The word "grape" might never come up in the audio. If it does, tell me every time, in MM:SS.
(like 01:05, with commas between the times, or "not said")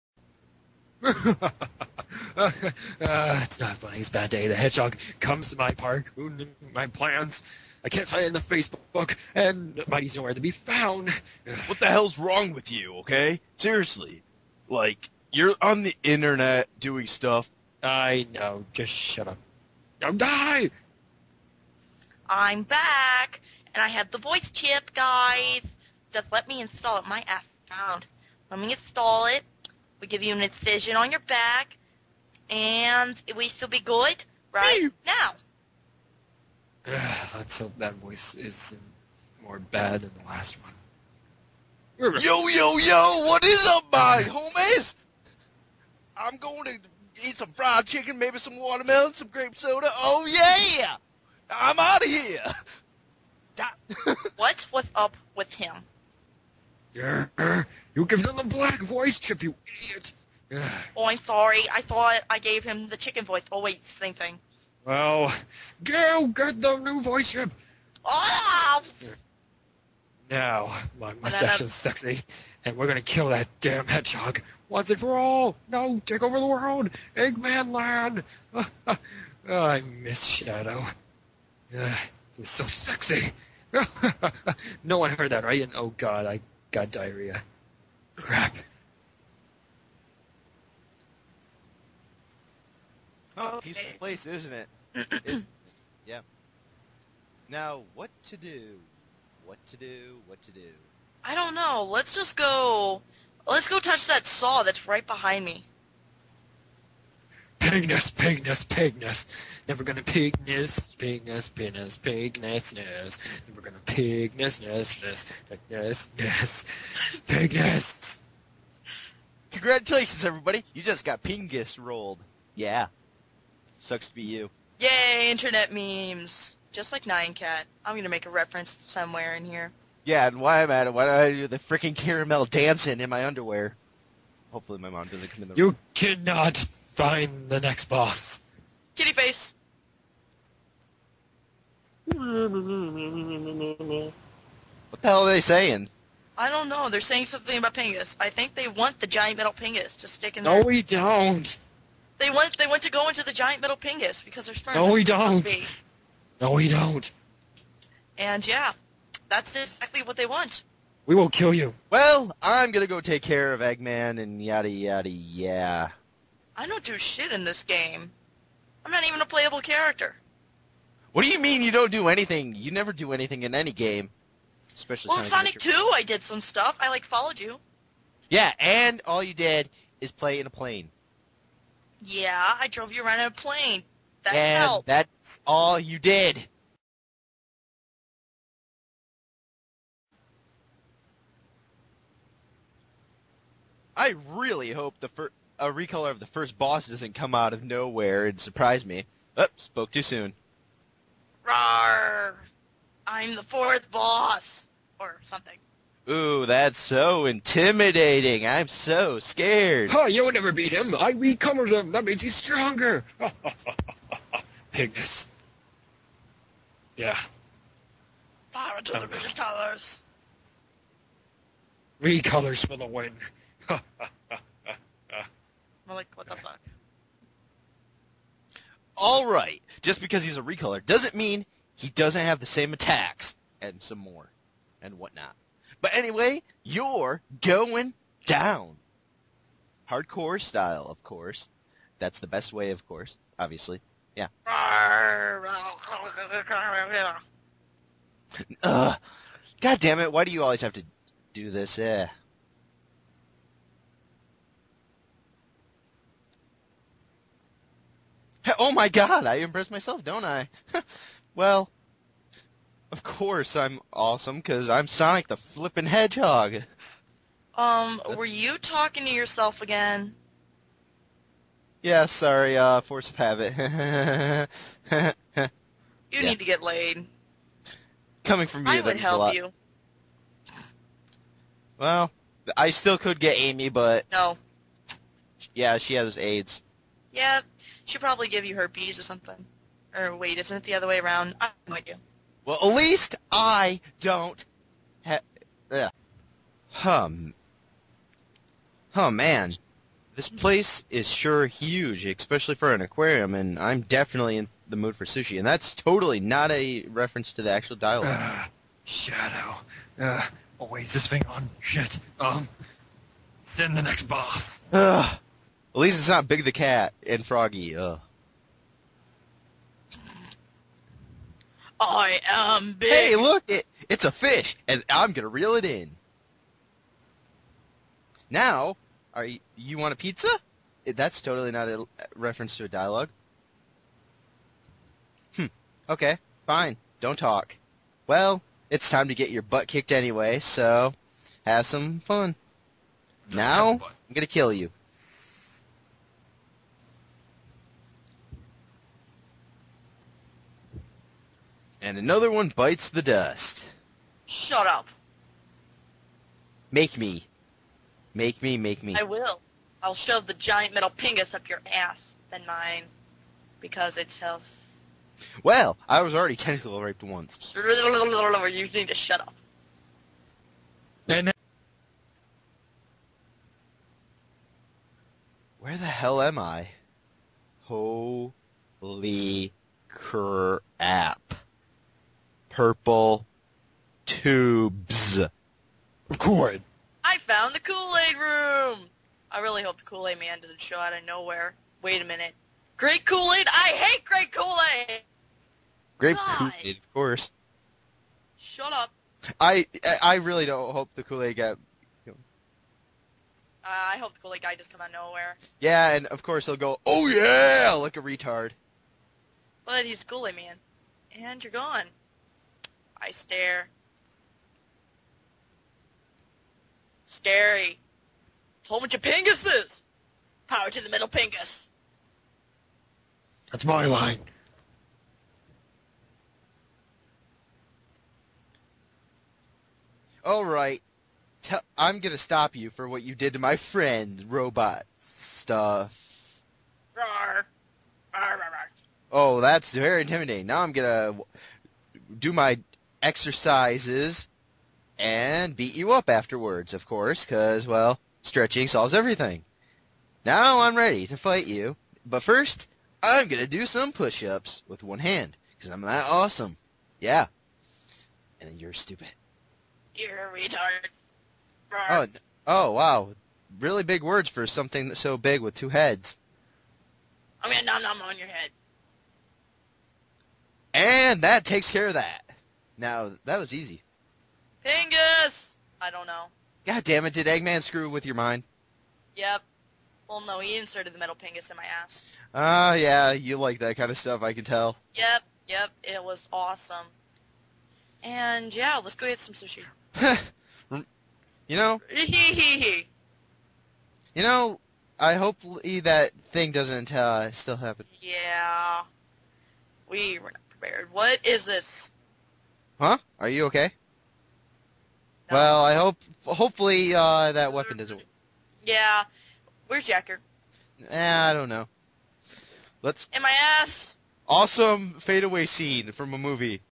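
00:49, 06:35.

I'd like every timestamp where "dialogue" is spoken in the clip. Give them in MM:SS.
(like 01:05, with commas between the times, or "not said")
05:07, 05:32.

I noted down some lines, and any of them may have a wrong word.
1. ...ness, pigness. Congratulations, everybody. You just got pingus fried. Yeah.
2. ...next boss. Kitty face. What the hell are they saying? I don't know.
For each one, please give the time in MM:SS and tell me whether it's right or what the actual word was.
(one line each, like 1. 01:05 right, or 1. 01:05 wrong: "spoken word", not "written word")
1. 01:56 wrong: "rolled", not "fried"
2. 02:17 right.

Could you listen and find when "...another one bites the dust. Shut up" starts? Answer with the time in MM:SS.
05:51.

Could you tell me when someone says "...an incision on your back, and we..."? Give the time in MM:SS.
00:30.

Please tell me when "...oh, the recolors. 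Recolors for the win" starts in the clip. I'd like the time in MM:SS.
03:38.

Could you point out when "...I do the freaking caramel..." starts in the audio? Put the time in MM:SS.
02:11.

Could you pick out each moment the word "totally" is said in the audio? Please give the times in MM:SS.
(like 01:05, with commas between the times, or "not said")
05:05, 05:31.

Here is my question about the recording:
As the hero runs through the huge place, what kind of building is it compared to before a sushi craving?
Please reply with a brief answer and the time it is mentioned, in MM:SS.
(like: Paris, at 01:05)
An aquarium, at 05:02.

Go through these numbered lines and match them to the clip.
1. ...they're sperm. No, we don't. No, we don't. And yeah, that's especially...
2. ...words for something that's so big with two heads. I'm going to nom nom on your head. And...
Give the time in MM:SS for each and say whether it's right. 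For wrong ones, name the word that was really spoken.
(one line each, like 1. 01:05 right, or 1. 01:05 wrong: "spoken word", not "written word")
1. 02:34 wrong: "exactly", not "especially"
2. 07:44 right.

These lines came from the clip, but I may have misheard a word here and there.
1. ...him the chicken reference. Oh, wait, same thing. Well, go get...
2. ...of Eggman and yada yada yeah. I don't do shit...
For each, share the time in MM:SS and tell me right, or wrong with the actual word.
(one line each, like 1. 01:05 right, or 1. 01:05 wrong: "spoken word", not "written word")
1. 01:02 wrong: "voice", not "reference"
2. 02:43 right.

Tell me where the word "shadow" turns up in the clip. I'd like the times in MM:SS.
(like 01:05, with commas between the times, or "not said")
01:20, 05:08.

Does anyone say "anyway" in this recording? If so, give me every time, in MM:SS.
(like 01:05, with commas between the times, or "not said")
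03:55, 05:39.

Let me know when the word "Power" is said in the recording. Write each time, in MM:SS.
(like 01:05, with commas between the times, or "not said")
03:38, 07:00.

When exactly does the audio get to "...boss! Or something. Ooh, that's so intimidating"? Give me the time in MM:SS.
03:23.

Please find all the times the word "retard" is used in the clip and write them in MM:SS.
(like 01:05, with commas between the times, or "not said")
06:48, 07:40.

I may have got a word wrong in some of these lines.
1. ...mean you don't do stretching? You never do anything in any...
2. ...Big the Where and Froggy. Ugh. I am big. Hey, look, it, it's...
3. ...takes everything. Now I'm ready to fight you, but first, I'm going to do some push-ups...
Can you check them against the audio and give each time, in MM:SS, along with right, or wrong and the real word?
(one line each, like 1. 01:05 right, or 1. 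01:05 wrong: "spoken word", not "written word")
1. 02:51 wrong: "anything", not "stretching"
2. 05:16 wrong: "Cat", not "Where"
3. 07:28 wrong: "solves", not "takes".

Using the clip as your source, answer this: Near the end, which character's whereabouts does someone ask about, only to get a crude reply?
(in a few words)
Yacker.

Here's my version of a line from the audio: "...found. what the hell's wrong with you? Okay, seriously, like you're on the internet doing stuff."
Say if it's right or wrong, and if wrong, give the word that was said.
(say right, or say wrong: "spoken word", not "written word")
right.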